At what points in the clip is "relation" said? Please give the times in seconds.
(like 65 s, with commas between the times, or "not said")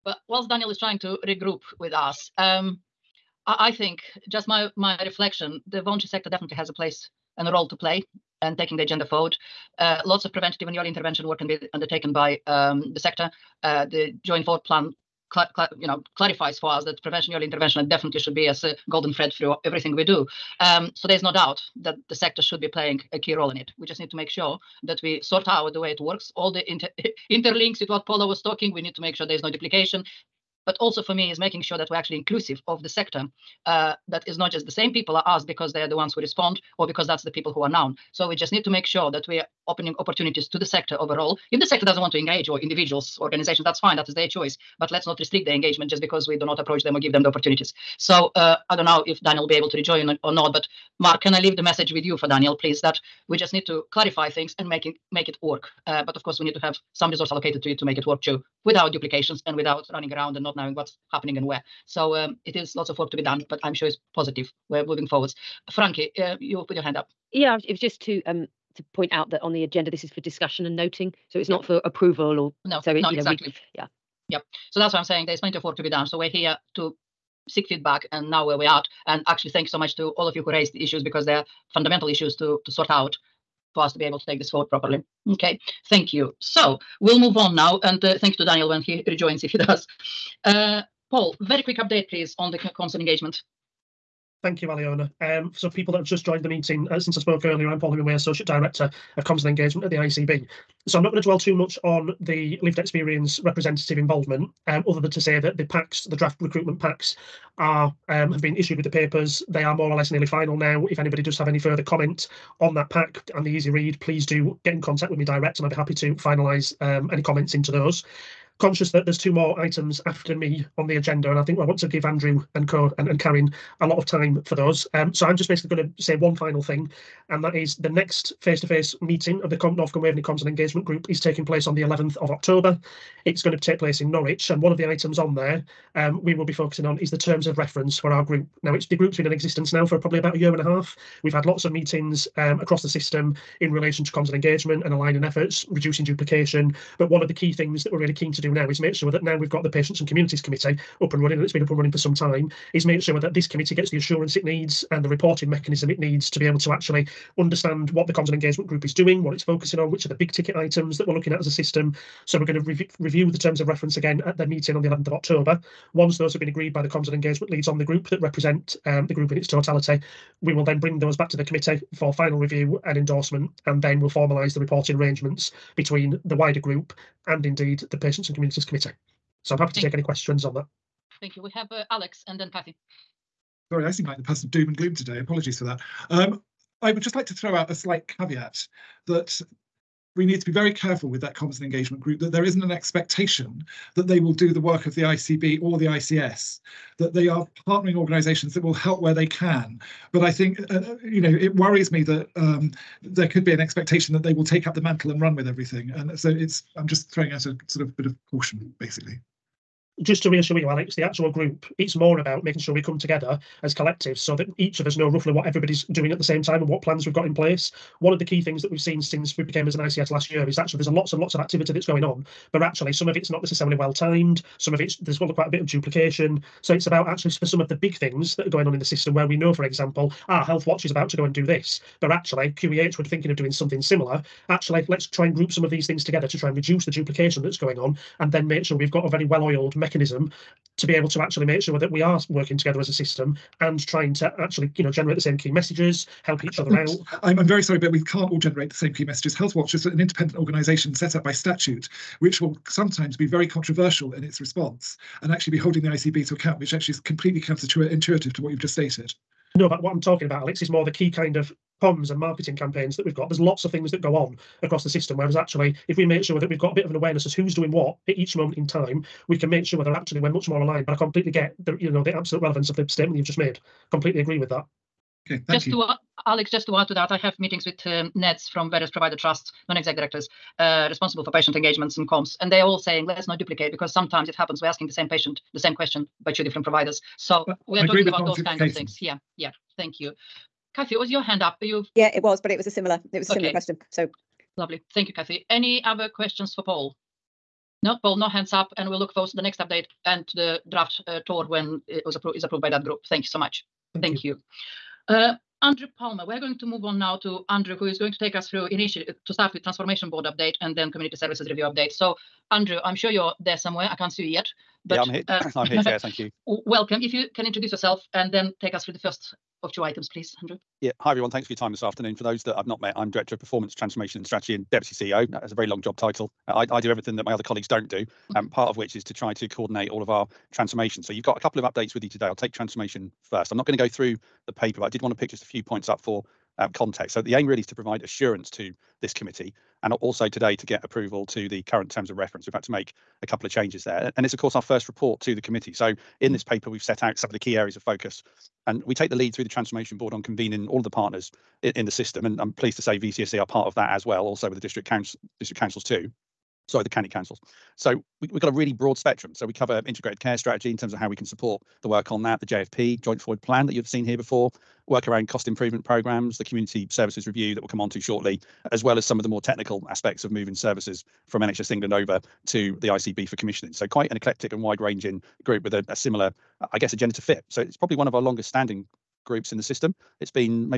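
143 s.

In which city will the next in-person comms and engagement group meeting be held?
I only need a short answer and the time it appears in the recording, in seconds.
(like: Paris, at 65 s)
Norwich, at 134 s.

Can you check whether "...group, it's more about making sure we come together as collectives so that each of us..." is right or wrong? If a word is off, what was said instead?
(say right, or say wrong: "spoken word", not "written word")
right.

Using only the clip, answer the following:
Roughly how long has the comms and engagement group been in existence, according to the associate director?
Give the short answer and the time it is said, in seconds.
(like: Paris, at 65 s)
A year and a half, at 140 s.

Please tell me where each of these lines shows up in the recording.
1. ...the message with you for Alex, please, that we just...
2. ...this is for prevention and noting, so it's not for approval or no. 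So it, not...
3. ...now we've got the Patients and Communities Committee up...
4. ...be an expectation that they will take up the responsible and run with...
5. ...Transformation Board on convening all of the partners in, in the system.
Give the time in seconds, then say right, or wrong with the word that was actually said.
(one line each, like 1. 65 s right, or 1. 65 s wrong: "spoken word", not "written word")
1. 51 s wrong: "Daniel", not "Alex"
2. 69 s wrong: "discussion", not "prevention"
3. 149 s right
4. 203 s wrong: "mantle", not "responsible"
5. 349 s right.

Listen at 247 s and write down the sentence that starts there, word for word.
I'm, I'm very sorry, but we can't all generate the same key messages.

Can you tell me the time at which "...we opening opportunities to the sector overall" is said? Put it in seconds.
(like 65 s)
39 s.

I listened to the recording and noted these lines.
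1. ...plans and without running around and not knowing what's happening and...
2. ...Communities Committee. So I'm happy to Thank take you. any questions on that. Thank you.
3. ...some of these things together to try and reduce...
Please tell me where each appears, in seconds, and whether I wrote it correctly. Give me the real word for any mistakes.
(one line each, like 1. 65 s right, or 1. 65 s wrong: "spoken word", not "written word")
1. 58 s wrong: "duplications", not "plans"
2. 178 s right
3. 235 s right.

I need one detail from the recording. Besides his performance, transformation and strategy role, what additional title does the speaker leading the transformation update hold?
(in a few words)
Deputy CEO.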